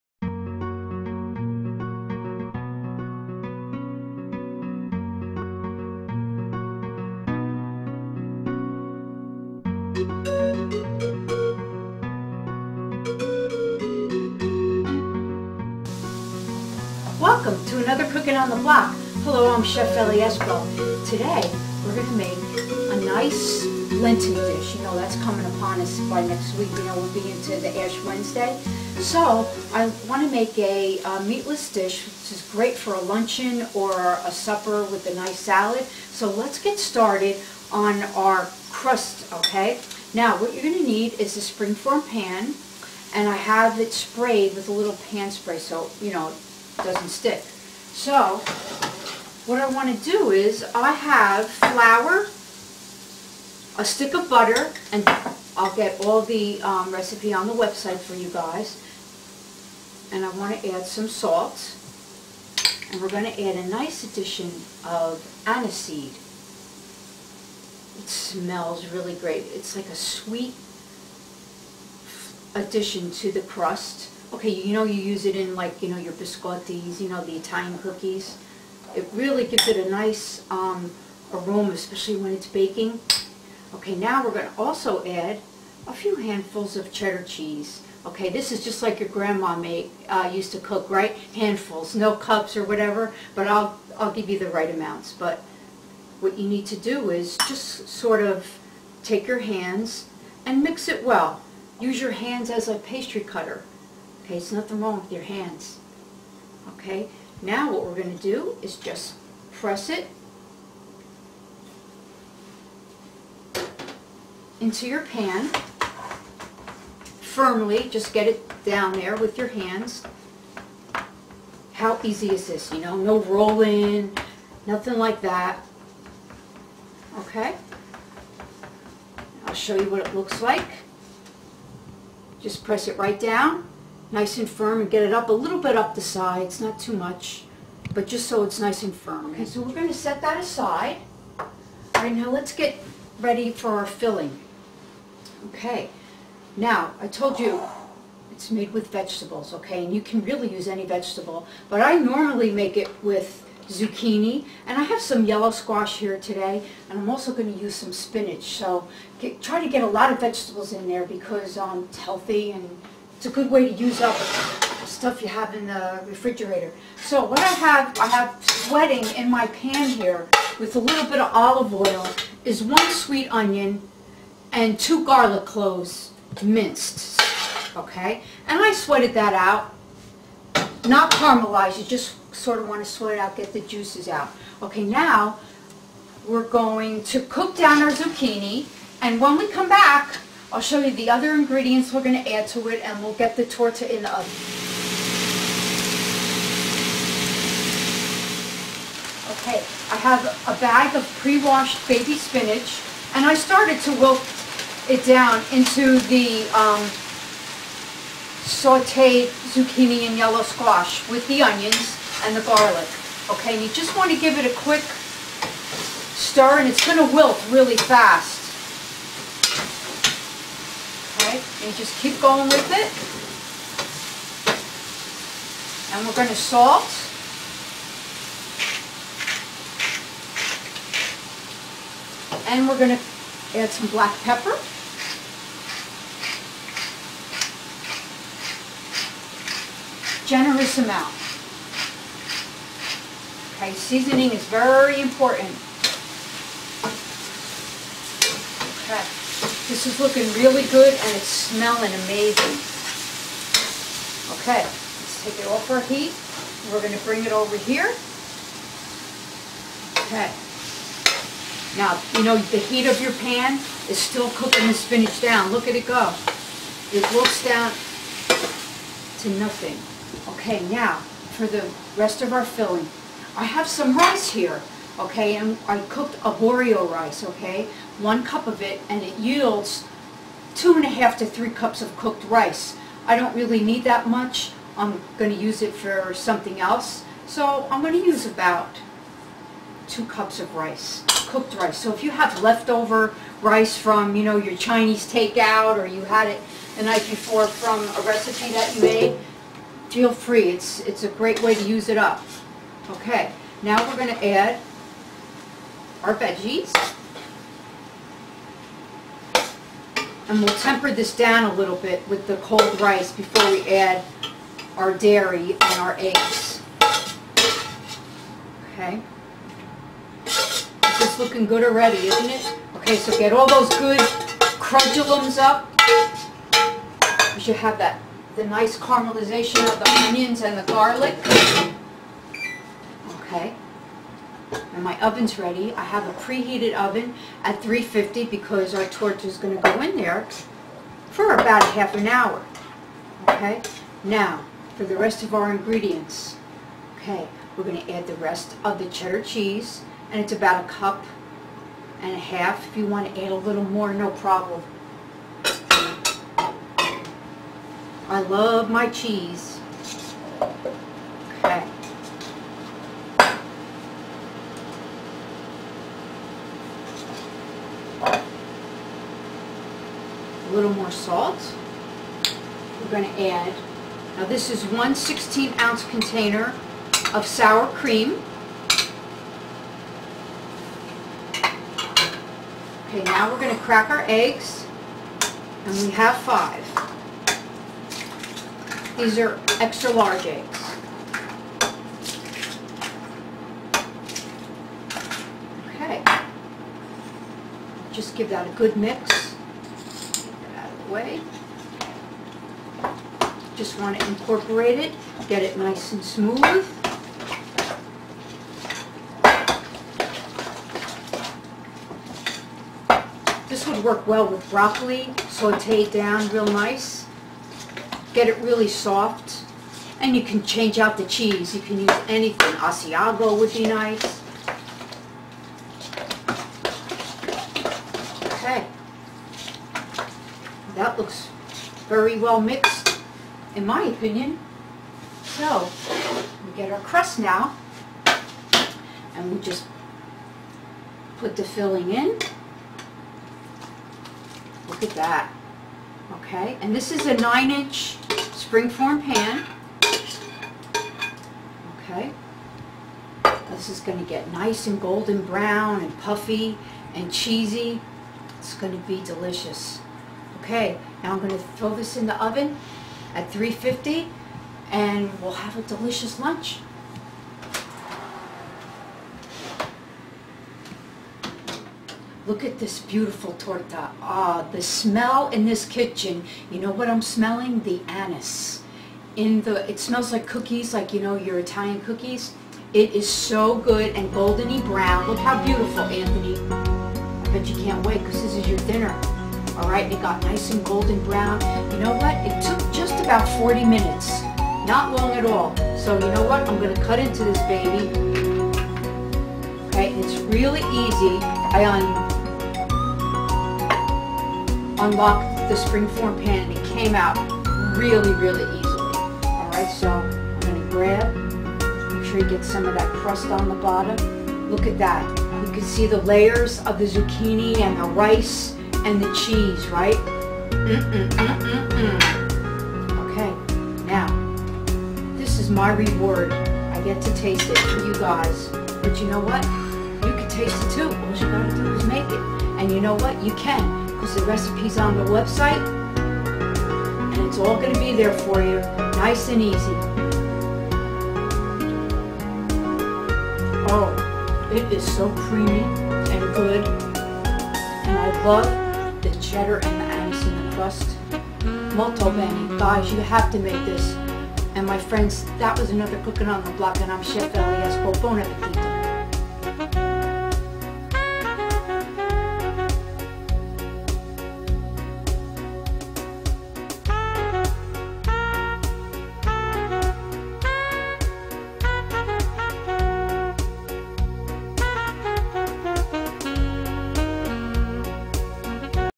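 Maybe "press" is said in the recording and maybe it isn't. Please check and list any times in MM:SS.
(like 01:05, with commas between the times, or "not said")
01:49, 02:12.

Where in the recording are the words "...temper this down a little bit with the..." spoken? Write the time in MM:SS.
05:10.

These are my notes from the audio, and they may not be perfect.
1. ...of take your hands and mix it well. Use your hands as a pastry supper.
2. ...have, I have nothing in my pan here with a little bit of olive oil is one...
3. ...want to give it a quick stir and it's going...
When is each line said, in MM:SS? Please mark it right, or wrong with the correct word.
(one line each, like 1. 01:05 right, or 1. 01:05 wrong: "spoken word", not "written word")
1. 01:38 wrong: "cutter", not "supper"
2. 02:47 wrong: "sweating", not "nothing"
3. 03:33 right.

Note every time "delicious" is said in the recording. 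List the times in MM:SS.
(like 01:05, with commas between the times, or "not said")
07:39, 07:45.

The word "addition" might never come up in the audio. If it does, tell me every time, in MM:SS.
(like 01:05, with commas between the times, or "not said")
01:04, 01:12.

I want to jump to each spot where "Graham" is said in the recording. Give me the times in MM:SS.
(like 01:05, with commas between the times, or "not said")
not said.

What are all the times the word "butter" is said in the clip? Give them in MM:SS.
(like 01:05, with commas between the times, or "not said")
00:54.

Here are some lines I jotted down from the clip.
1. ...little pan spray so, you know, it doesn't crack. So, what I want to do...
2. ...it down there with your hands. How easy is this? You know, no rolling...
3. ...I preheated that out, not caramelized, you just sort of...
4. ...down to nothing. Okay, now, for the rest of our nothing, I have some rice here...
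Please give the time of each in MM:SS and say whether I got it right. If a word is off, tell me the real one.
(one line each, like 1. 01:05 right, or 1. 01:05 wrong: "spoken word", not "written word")
1. 00:44 wrong: "stick", not "crack"
2. 01:58 right
3. 02:58 wrong: "sweated", not "preheated"
4. 04:27 wrong: "filling", not "nothing".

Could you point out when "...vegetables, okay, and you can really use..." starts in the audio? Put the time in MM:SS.
02:28.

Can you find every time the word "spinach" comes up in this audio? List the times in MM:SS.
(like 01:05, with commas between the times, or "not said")
02:37, 03:22, 04:24.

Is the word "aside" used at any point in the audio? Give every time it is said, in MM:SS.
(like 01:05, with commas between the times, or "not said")
02:20.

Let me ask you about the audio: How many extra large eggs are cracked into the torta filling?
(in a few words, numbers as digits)
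5.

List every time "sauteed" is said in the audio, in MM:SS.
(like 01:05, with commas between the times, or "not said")
03:28, 06:55.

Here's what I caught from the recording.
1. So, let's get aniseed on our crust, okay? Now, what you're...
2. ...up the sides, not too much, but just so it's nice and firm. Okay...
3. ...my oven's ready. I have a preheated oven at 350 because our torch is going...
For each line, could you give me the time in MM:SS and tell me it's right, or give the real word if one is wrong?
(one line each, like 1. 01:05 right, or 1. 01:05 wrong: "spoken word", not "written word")
1. 00:36 wrong: "started", not "aniseed"
2. 02:15 right
3. 05:34 right.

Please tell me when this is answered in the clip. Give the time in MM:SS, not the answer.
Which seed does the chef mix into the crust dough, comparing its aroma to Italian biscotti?
01:05.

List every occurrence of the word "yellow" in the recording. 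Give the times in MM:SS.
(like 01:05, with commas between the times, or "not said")
02:35, 03:30.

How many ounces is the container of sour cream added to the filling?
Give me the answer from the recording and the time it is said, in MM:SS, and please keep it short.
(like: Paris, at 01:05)
16, at 06:14.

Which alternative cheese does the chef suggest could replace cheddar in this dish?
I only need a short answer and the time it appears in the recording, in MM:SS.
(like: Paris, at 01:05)
Asiago, at 07:02.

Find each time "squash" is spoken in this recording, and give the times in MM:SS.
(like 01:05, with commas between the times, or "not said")
02:35, 03:30.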